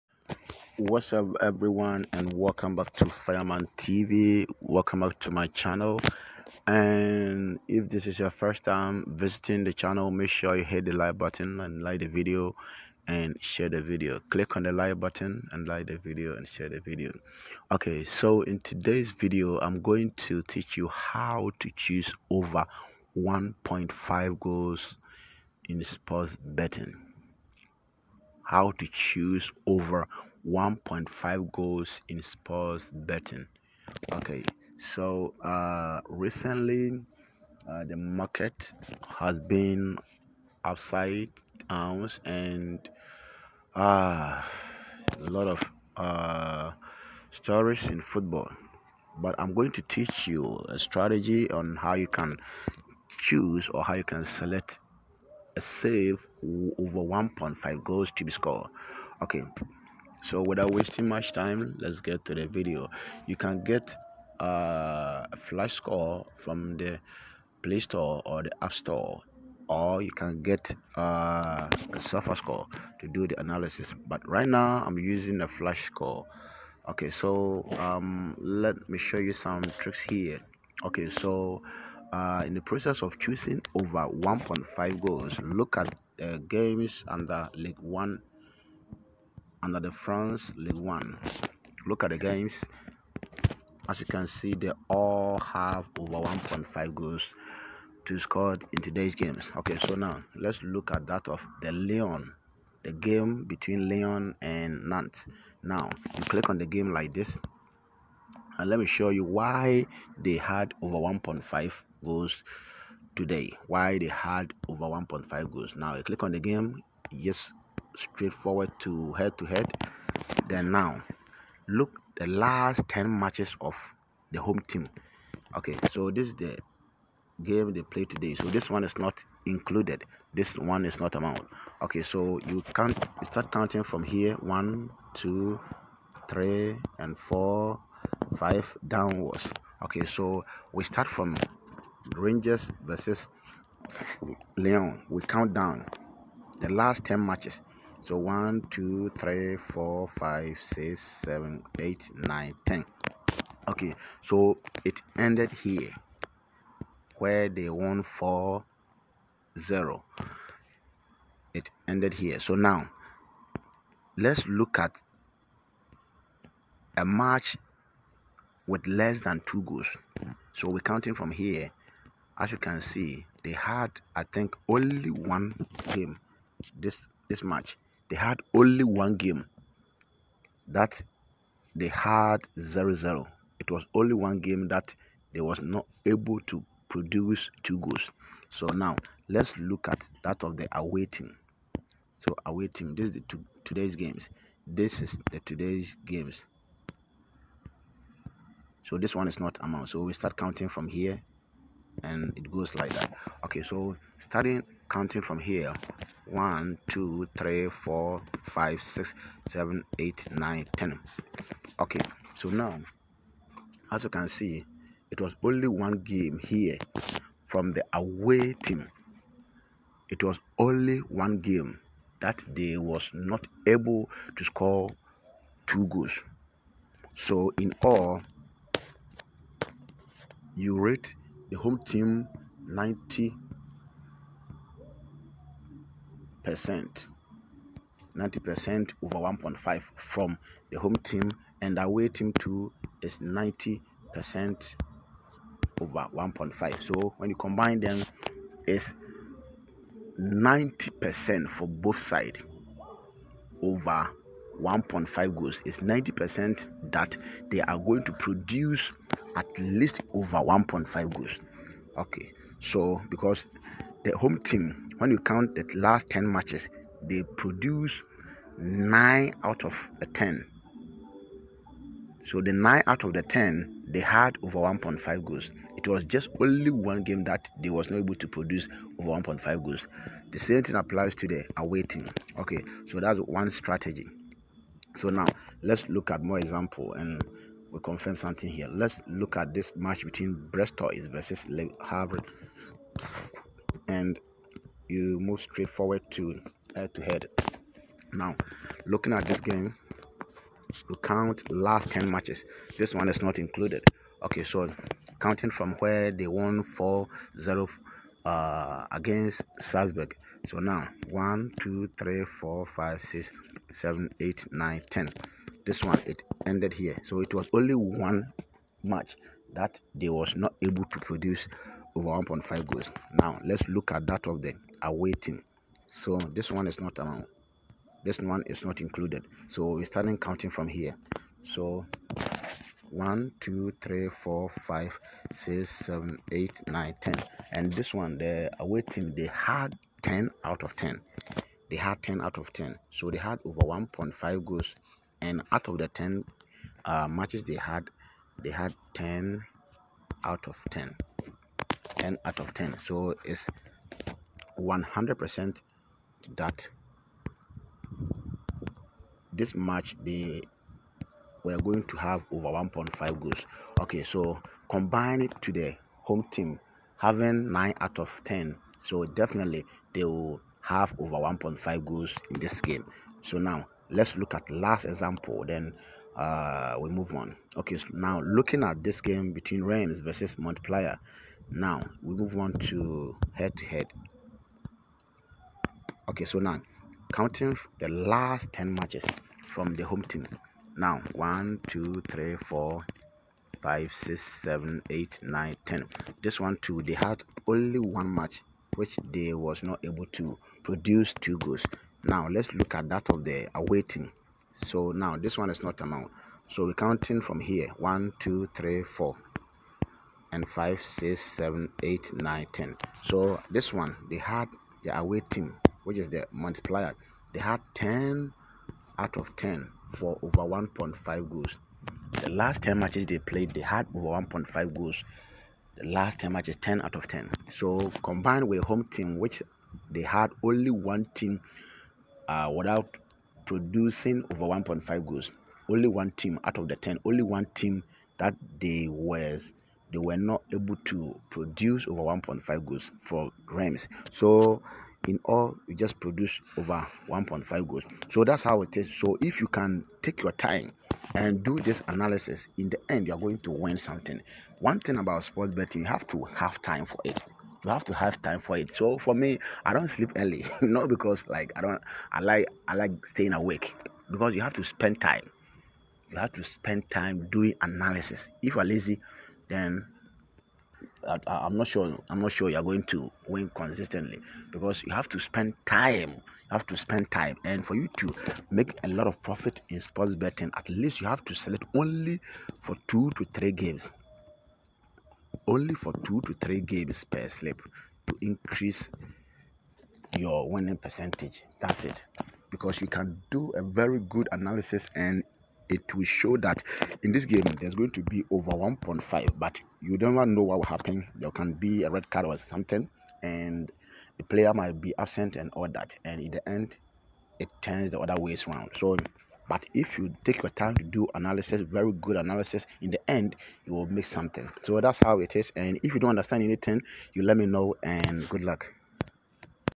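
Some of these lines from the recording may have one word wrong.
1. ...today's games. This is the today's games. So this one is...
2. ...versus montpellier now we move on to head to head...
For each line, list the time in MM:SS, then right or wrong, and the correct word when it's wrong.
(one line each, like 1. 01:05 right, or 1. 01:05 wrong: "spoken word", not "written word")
1. 03:13 right
2. 06:19 right.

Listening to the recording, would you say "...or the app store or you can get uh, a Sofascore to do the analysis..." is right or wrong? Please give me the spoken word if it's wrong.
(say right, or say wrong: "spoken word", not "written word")
right.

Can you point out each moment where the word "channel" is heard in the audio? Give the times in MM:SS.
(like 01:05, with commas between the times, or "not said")
00:05, 00:09.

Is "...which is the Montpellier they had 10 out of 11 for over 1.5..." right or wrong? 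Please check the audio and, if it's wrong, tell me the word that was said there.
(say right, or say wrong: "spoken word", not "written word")
wrong: "10", not "11".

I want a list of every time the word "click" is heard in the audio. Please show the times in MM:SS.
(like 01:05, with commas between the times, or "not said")
00:14, 01:46, 01:56.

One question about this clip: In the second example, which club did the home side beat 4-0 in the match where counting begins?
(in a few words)
Salzburg.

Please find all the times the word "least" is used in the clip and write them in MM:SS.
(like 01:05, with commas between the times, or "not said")
04:19, 08:00.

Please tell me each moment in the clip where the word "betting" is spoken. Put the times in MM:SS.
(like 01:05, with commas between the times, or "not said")
00:26, 00:33, 07:35, 08:00.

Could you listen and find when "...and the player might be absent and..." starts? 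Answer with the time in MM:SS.
08:23.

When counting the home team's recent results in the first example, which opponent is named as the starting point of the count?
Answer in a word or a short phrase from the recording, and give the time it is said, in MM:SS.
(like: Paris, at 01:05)
Rangers, at 02:22.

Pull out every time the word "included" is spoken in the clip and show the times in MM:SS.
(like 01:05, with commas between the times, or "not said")
02:09, 05:03, 05:28.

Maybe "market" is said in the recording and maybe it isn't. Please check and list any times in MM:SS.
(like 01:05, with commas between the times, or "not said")
00:37.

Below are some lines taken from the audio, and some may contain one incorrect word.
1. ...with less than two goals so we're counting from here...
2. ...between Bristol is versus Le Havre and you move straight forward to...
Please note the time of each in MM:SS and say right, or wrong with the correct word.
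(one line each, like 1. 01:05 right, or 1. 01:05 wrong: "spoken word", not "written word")
1. 02:48 right
2. 04:50 right.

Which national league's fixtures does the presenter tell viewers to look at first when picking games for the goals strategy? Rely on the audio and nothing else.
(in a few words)
France League One.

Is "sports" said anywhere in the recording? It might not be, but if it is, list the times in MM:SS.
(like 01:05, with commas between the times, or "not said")
00:25, 00:32, 07:35, 07:59.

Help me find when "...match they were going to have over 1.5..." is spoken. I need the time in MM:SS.
05:59.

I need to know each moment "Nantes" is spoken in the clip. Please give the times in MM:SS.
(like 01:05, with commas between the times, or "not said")
01:44.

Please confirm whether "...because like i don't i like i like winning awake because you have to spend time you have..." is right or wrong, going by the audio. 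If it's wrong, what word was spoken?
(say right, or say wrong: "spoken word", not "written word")
wrong: "staying", not "winning".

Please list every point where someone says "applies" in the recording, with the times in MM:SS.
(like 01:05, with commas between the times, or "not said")
04:40.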